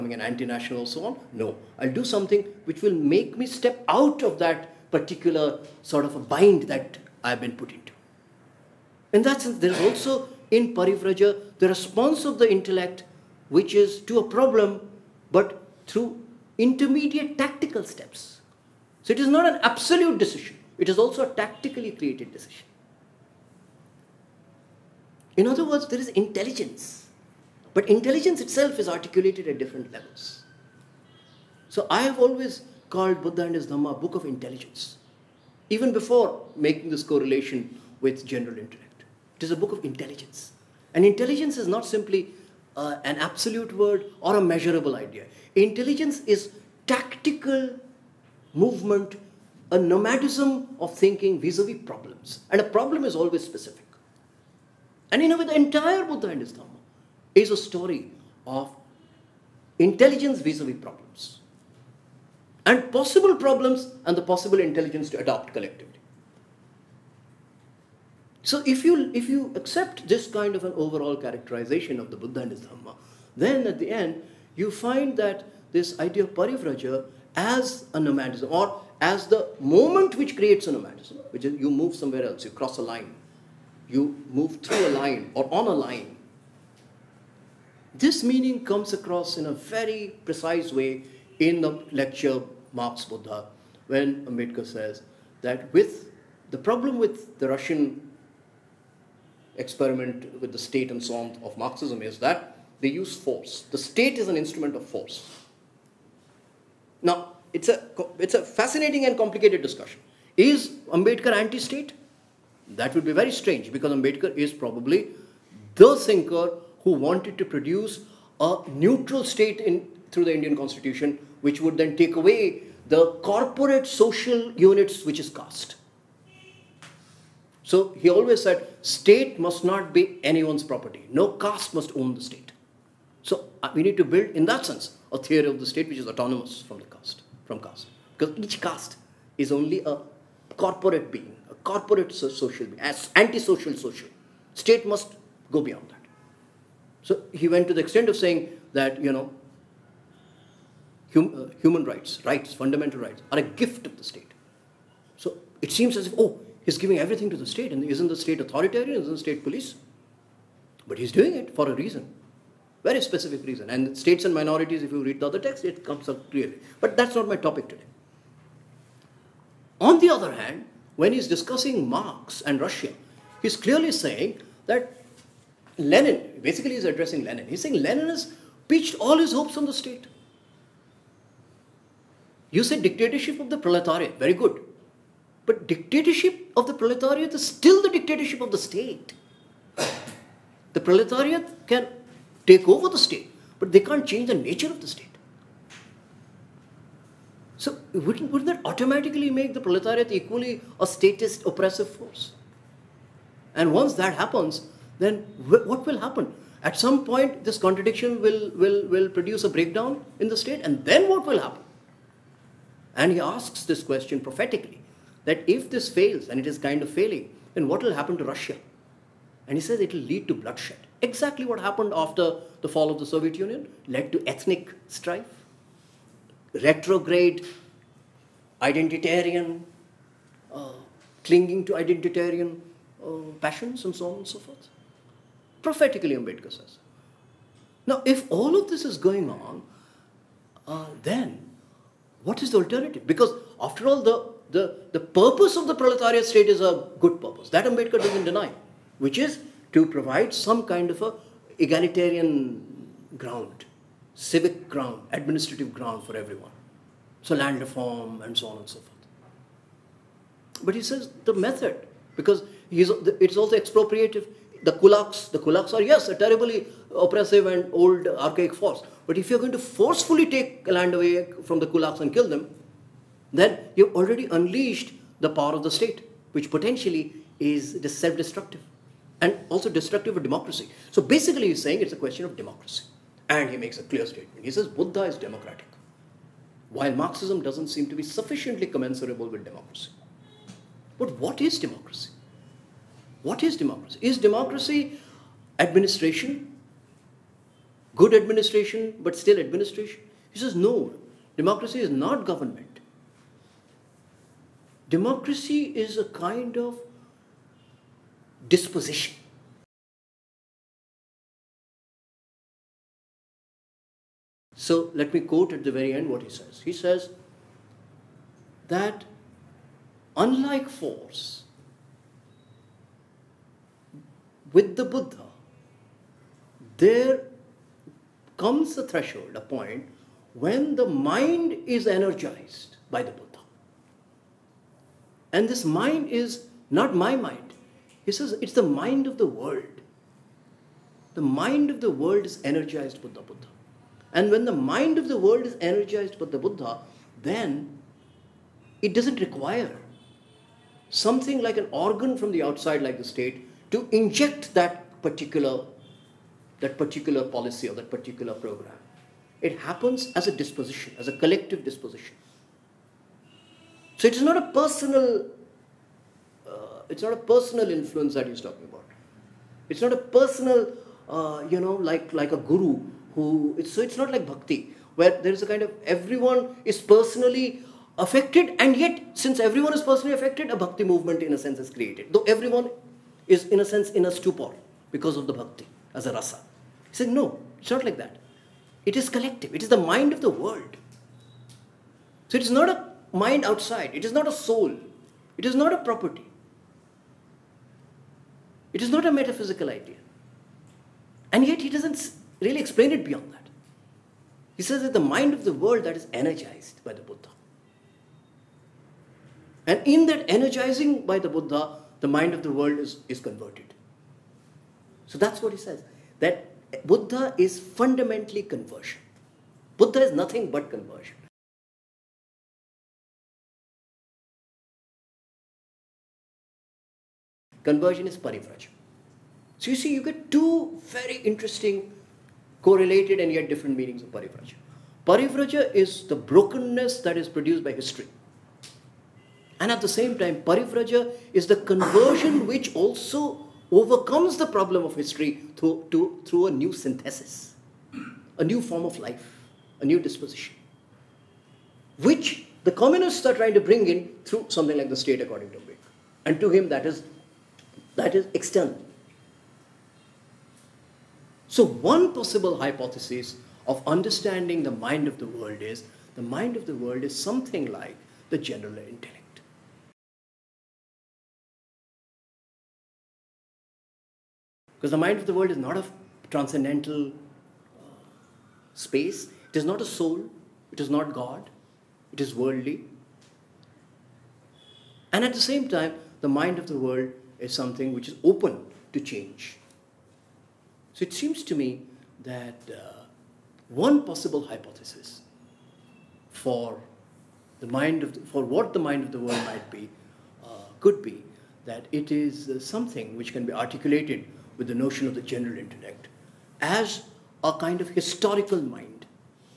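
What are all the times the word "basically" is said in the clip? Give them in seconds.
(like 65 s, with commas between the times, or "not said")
176 s, 281 s.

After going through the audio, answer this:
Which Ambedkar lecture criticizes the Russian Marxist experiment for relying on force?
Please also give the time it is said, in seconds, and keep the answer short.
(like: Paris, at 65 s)
Marx Buddha, at 92 s.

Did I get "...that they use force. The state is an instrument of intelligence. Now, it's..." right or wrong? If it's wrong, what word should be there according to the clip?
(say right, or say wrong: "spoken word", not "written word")
wrong: "force", not "intelligence".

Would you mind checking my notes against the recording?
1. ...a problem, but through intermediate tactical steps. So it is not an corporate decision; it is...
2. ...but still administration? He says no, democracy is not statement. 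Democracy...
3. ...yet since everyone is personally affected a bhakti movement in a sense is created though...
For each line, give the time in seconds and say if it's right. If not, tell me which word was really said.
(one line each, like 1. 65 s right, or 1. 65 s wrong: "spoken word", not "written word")
1. 14 s wrong: "absolute", not "corporate"
2. 299 s wrong: "government", not "statement"
3. 378 s right.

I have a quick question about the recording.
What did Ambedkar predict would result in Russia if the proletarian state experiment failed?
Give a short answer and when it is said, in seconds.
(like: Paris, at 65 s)
Bloodshed, at 220 s.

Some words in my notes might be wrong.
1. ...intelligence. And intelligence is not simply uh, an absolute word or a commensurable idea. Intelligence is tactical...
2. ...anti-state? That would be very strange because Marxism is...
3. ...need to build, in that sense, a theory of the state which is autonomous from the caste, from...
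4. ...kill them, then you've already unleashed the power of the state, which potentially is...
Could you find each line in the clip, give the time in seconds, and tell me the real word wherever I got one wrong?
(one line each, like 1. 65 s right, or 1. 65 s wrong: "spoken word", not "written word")
1. 39 s wrong: "measurable", not "commensurable"
2. 111 s wrong: "Ambedkar", not "Marxism"
3. 133 s right
4. 272 s right.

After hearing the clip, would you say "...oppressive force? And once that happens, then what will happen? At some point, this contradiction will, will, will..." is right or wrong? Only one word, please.
right.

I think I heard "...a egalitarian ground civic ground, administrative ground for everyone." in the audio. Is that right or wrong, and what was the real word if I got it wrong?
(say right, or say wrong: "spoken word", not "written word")
right.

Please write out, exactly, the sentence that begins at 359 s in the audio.
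It happens as a disposition, as a collective disposition.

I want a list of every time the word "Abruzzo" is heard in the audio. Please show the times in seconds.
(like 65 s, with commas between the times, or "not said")
not said.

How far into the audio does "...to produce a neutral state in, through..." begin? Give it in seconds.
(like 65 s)
117 s.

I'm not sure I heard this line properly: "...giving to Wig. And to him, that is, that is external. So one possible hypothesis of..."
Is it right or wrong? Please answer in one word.
wrong.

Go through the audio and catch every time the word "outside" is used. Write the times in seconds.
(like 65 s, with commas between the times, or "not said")
352 s, 393 s.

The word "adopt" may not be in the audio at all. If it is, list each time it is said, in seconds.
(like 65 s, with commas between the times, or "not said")
65 s.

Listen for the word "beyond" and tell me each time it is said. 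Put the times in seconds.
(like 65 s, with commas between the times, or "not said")
145 s, 403 s.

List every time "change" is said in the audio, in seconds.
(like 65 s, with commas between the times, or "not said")
194 s, 489 s.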